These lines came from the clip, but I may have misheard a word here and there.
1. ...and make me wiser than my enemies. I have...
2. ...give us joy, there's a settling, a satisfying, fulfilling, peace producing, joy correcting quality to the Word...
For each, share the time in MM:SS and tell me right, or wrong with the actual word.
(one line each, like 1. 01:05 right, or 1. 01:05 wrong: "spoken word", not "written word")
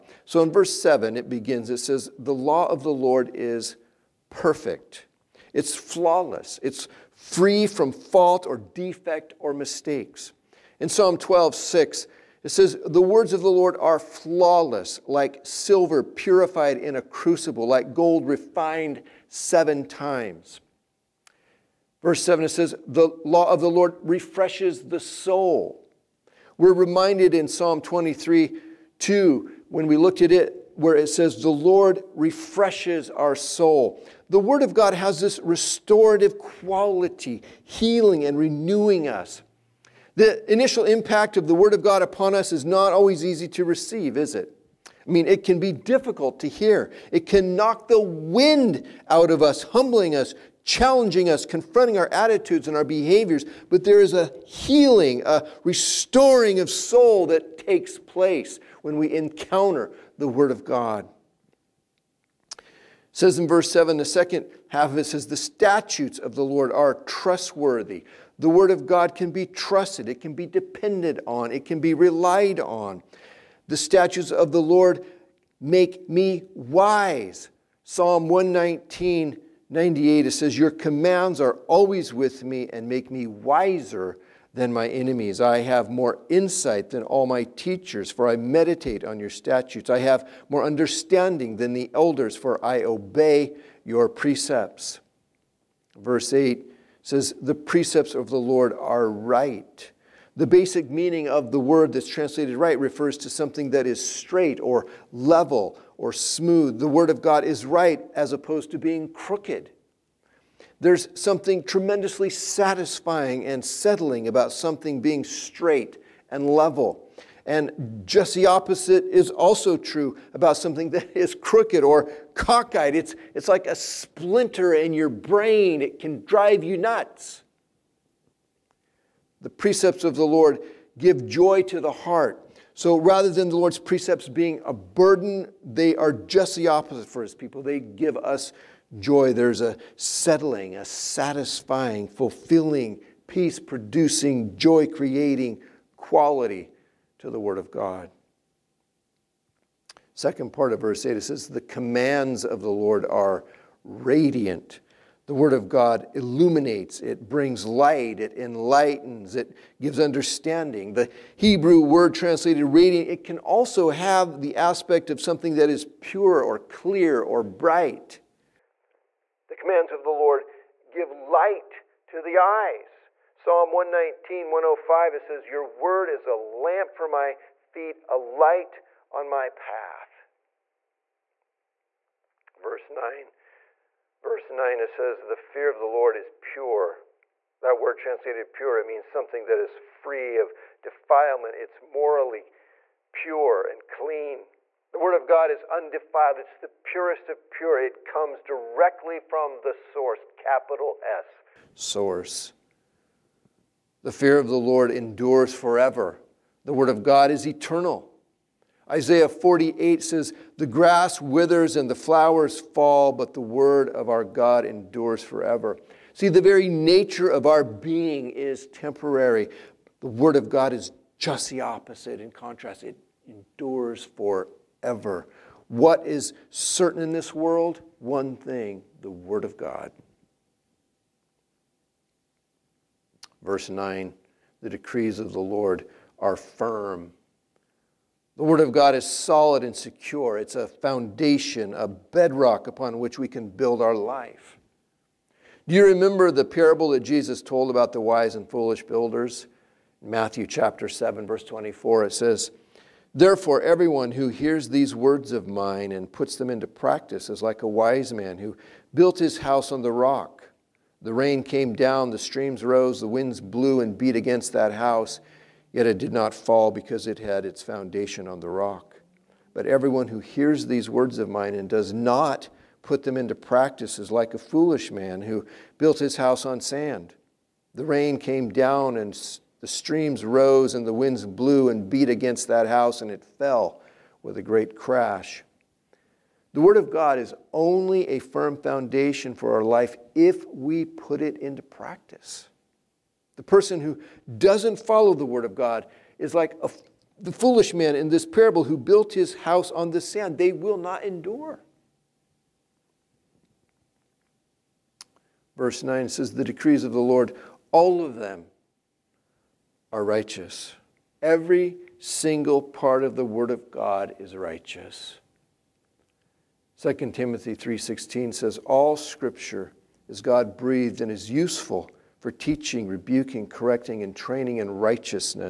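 1. 01:22 right
2. 02:17 wrong: "creating", not "correcting".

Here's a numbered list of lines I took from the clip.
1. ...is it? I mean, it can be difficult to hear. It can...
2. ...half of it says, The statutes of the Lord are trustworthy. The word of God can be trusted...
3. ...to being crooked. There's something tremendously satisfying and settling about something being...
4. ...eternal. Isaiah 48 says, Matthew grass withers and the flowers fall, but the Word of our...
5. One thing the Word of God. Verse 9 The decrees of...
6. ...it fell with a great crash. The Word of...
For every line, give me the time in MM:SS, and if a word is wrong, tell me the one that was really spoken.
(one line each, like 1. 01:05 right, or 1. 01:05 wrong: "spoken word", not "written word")
1. 00:44 right
2. 01:04 right
3. 01:48 right
4. 03:27 wrong: "The", not "Matthew"
5. 03:47 right
6. 04:43 right.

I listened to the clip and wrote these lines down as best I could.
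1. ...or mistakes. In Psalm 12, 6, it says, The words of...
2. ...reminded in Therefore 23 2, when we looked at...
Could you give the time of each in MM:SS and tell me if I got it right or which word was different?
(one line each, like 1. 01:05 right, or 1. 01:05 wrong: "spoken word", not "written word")
1. 00:09 right
2. 00:26 wrong: "Psalm", not "Therefore".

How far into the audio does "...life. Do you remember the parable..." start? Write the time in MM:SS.
04:03.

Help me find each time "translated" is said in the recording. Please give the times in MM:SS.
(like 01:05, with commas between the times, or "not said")
01:42, 02:42, 03:07.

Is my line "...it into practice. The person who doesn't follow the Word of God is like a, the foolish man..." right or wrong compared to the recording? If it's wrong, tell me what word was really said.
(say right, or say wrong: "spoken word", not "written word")
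right.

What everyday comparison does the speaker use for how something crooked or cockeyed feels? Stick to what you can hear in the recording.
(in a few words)
A splinter in your brain.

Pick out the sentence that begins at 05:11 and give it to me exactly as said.
Every single part of the word of God is righteous.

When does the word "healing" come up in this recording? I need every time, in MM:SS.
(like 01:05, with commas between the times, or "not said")
00:37, 00:54.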